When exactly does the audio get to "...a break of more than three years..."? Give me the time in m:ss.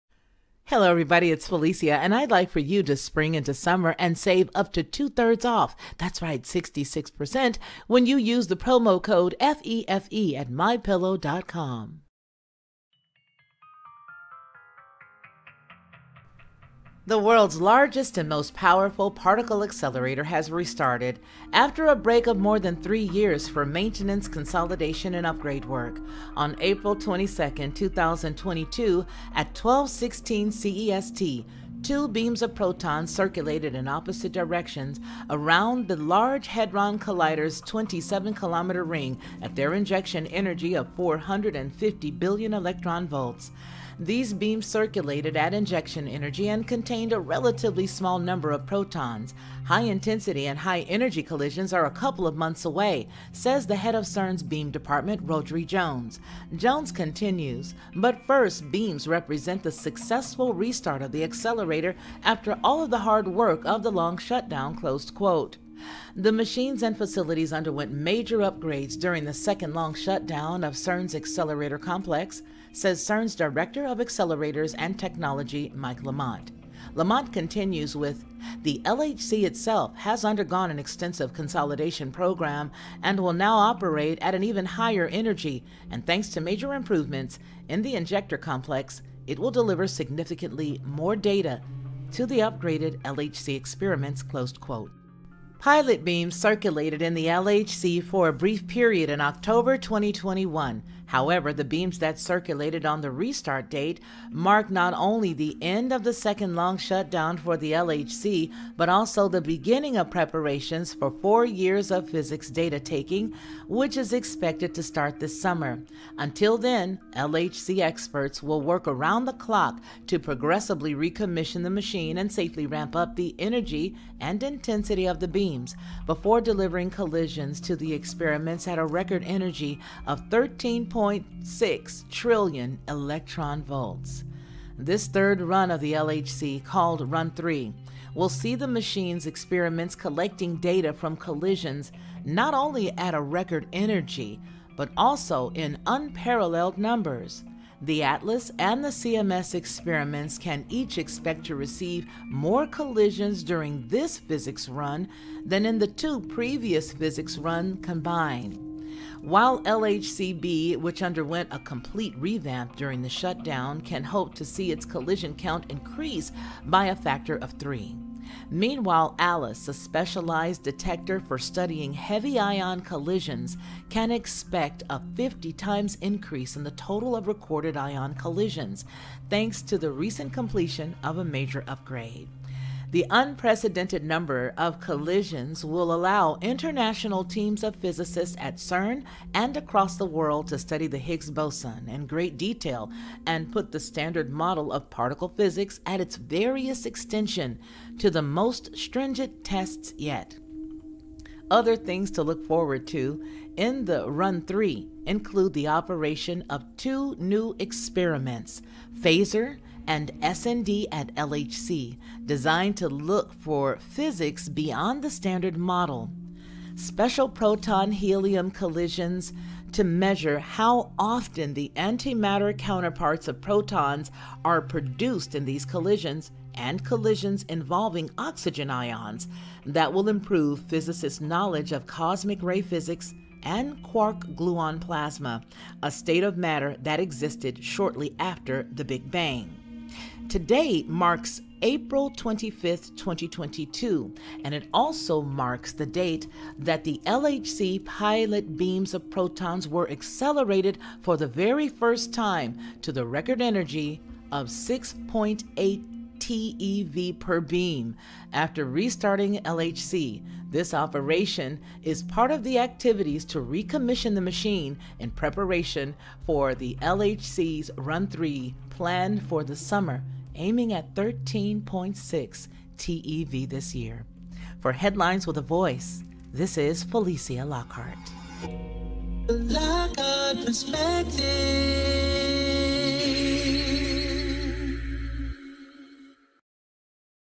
0:21.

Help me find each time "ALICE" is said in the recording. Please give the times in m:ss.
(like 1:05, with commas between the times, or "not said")
2:49.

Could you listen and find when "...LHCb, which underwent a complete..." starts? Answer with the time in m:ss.
2:39.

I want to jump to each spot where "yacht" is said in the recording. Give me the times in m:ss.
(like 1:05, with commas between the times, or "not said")
not said.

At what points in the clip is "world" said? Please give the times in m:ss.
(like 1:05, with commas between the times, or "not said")
0:17, 3:10.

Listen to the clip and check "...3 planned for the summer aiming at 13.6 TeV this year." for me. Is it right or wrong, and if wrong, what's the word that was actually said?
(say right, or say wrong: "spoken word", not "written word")
right.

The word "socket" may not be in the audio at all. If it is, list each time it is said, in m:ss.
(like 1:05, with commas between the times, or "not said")
not said.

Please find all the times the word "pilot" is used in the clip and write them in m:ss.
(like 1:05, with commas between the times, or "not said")
1:35, 4:07.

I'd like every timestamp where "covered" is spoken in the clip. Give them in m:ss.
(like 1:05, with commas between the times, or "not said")
not said.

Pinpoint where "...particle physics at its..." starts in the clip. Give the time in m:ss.
3:14.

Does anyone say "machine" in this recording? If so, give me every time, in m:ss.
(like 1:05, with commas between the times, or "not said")
1:06, 2:01, 2:18, 4:24.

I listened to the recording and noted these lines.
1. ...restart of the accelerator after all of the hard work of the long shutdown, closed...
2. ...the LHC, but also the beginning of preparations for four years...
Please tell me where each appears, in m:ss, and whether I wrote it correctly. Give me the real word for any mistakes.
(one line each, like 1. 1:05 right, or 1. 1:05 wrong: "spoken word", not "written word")
1. 1:00 right
2. 1:47 right.